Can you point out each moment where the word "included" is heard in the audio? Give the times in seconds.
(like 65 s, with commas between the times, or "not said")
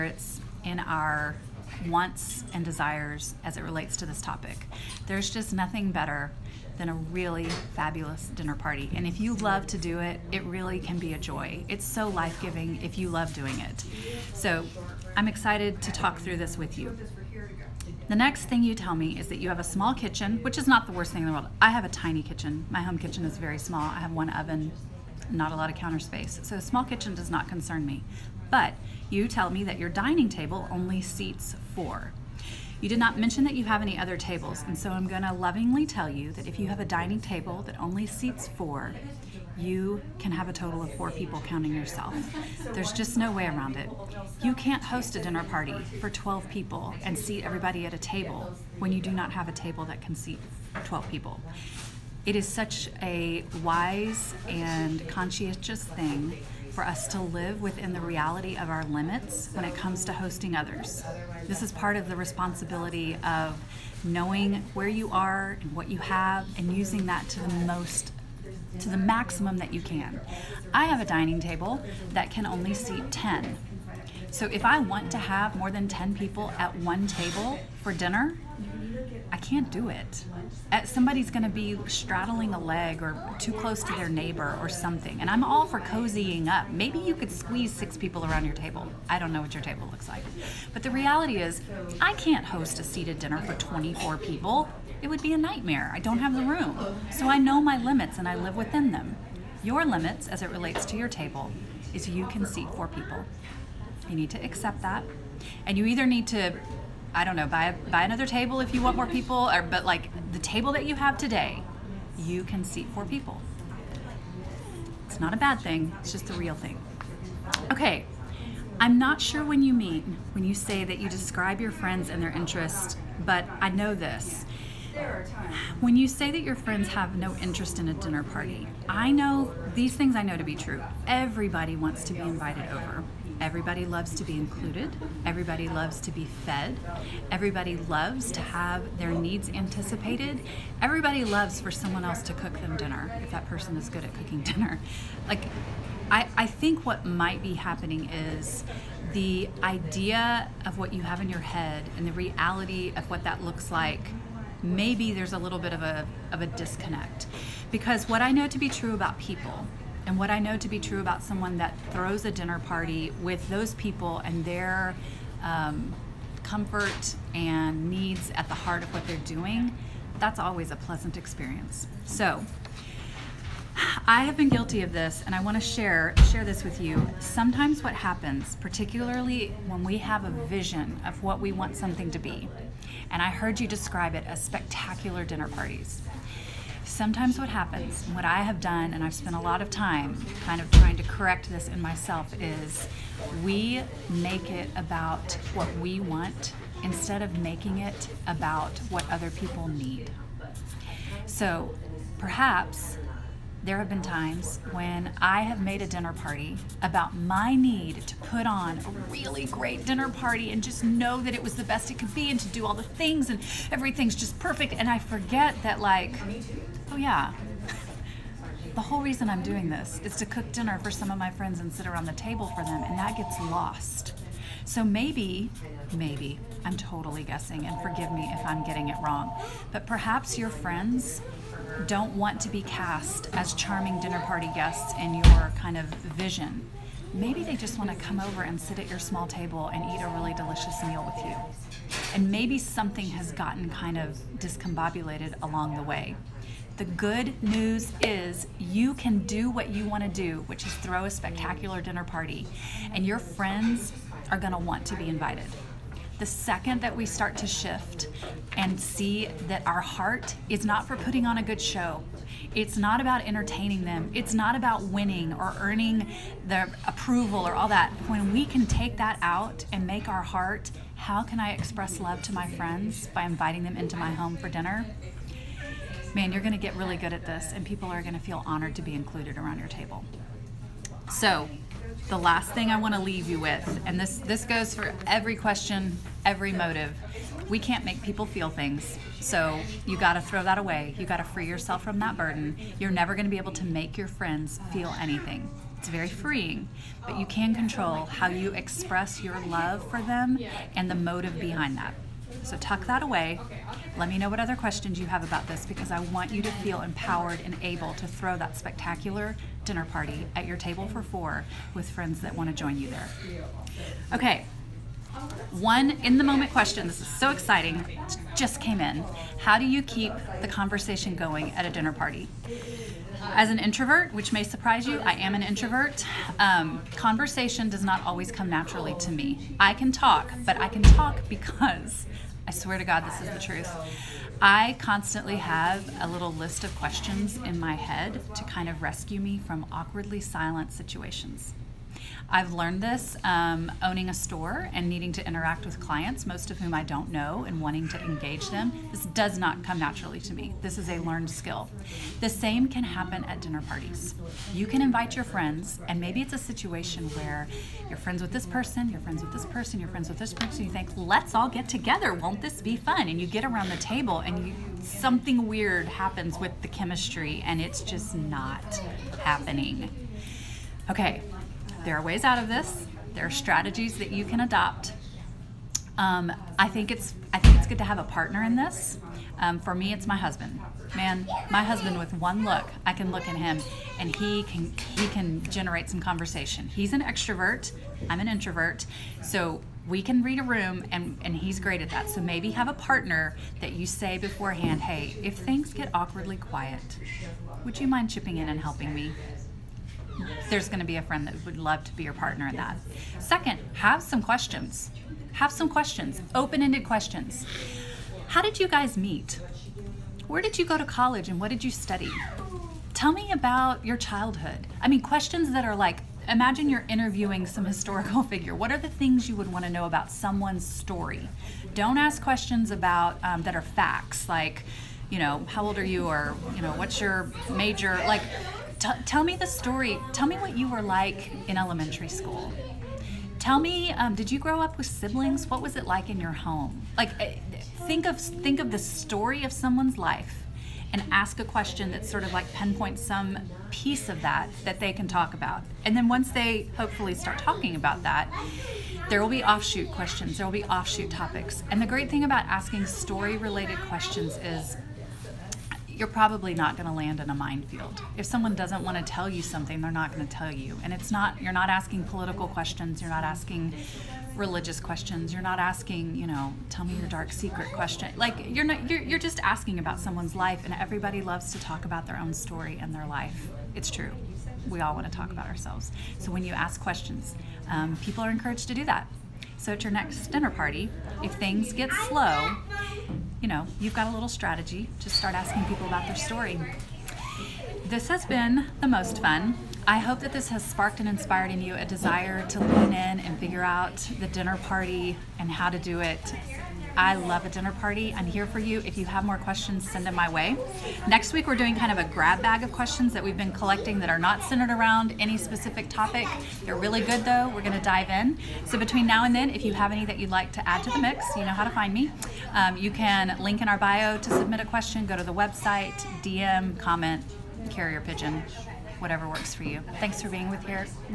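134 s, 278 s.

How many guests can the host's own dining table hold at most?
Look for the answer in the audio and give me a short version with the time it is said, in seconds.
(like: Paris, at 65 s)
10, at 72 s.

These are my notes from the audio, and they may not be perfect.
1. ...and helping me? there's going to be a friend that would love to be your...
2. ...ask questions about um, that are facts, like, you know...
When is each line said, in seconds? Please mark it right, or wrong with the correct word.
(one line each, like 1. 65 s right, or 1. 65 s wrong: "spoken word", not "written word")
1. 398 s right
2. 421 s right.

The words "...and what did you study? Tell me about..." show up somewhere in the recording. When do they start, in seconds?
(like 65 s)
411 s.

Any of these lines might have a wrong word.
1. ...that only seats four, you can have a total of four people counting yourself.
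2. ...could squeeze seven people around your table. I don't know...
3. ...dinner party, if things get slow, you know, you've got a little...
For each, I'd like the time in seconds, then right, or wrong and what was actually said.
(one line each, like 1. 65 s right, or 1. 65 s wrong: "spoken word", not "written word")
1. 37 s right
2. 87 s wrong: "six", not "seven"
3. 480 s right.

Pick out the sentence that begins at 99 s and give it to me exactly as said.
Your limits, as it relates to your table, is you can seat four people.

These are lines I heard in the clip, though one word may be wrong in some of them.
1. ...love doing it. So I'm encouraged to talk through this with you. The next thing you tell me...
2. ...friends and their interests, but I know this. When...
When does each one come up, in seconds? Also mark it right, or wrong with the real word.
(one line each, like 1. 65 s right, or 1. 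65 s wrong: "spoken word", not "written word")
1. 13 s wrong: "excited", not "encouraged"
2. 121 s right.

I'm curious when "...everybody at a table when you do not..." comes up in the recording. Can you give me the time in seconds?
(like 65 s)
47 s.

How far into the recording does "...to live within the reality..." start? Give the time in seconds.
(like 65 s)
57 s.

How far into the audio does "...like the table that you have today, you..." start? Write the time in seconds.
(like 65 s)
109 s.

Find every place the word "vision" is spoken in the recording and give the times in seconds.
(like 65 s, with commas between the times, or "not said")
180 s, 236 s.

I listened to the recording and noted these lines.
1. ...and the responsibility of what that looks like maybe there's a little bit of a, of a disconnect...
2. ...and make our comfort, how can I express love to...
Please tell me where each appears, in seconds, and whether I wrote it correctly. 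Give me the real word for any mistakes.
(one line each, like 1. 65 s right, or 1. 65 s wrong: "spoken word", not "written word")
1. 151 s wrong: "reality", not "responsibility"
2. 269 s wrong: "heart", not "comfort".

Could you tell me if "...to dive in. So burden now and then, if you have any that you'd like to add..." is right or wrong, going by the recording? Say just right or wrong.
wrong.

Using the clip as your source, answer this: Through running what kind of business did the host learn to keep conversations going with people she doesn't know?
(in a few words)
a store.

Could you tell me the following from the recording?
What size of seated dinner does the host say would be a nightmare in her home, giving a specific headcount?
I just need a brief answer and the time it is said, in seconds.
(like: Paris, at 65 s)
24, at 93 s.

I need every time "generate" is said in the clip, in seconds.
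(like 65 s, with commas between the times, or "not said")
385 s.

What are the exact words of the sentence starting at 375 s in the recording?
Um, I think it's I think it's good to have a partner in this.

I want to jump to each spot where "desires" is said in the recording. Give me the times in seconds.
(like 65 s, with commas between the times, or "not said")
2 s, 491 s.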